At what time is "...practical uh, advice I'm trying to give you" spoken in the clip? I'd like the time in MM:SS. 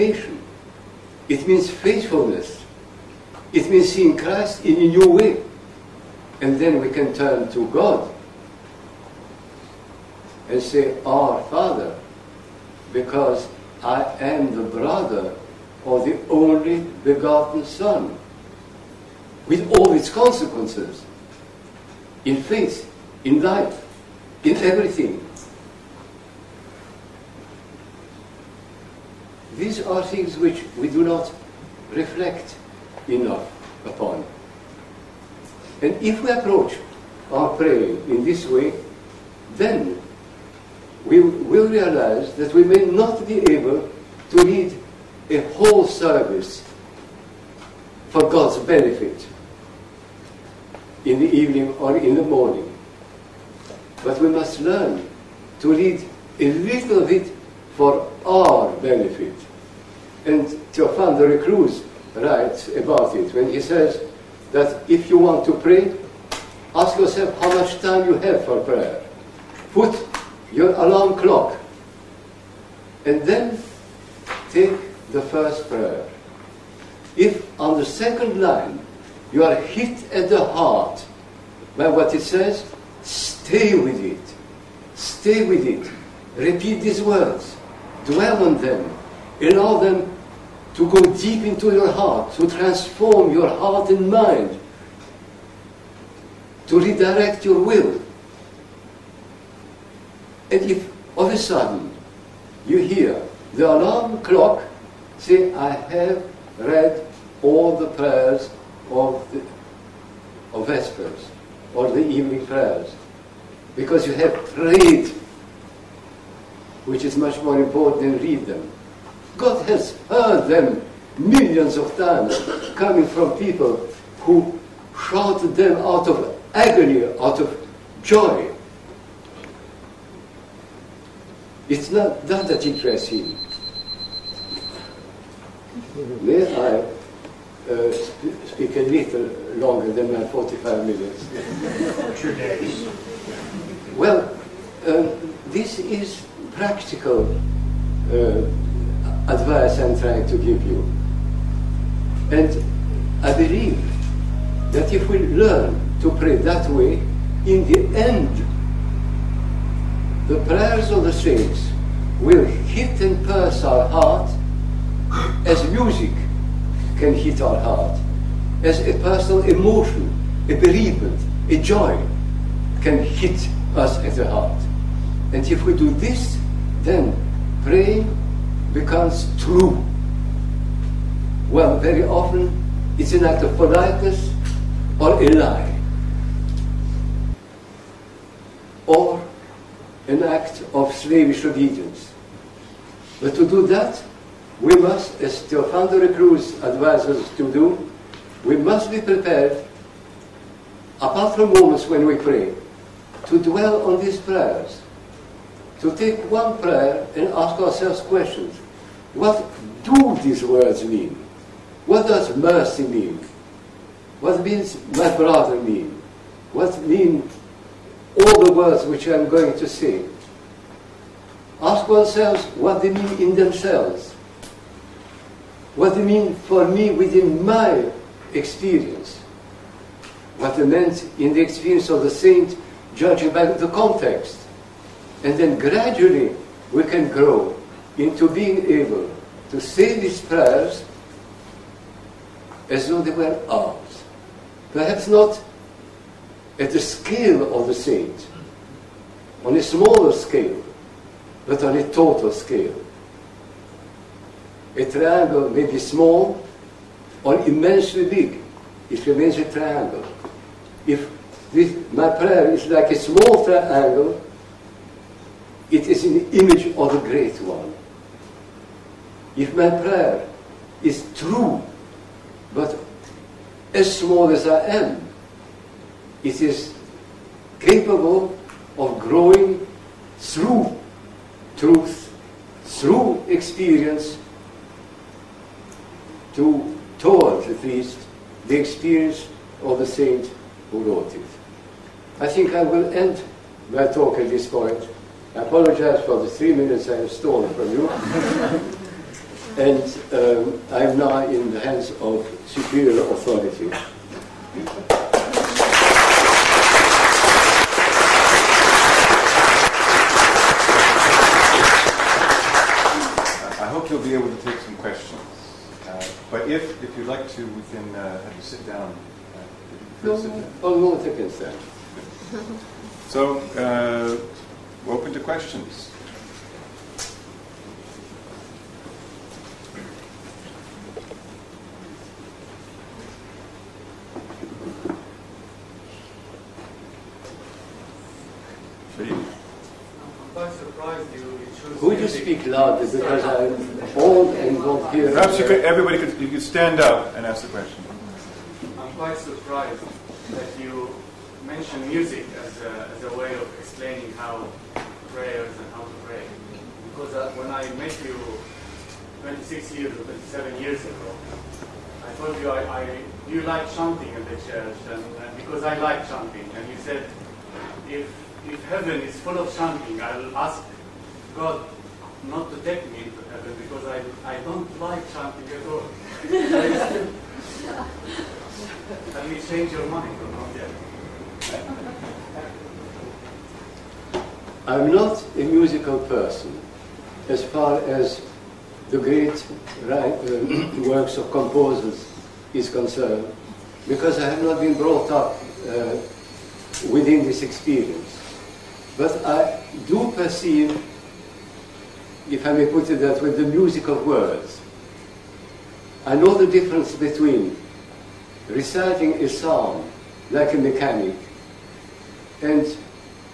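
02:26.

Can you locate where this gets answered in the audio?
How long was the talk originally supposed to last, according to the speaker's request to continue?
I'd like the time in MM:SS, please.
02:20.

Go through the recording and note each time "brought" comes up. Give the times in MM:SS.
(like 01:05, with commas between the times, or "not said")
06:34.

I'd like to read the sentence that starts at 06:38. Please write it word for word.
But I do perceive if I may put it that way, the music of words.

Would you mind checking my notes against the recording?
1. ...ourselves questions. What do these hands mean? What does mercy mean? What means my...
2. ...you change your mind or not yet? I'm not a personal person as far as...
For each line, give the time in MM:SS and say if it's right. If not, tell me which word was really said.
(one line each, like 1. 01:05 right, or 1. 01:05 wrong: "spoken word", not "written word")
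1. 03:27 wrong: "words", not "hands"
2. 06:19 wrong: "musical", not "personal".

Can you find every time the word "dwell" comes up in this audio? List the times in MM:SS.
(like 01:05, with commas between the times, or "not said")
01:28, 03:23.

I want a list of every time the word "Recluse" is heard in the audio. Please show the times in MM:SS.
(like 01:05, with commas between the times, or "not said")
01:01, 03:15.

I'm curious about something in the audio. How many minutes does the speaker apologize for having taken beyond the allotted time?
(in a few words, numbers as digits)
3.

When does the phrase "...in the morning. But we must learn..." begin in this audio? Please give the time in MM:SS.
00:51.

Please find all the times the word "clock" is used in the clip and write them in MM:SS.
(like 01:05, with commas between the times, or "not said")
01:11, 01:44.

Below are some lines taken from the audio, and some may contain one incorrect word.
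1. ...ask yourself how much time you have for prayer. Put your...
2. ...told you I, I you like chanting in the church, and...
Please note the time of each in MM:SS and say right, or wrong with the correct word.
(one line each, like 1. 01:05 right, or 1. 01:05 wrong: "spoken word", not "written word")
1. 01:06 right
2. 06:02 right.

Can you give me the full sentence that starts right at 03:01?
Well, very often it's an act of politeness or a lie.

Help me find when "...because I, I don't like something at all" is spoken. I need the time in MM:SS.
06:13.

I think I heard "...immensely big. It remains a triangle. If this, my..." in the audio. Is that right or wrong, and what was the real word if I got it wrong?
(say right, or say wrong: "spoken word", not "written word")
right.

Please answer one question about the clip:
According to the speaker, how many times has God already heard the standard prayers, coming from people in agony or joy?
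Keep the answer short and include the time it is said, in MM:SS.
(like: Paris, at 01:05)
Millions of times, at 02:01.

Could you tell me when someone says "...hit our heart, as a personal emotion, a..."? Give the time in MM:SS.
02:47.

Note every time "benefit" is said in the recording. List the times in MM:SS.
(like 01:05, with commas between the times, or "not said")
00:48, 00:58.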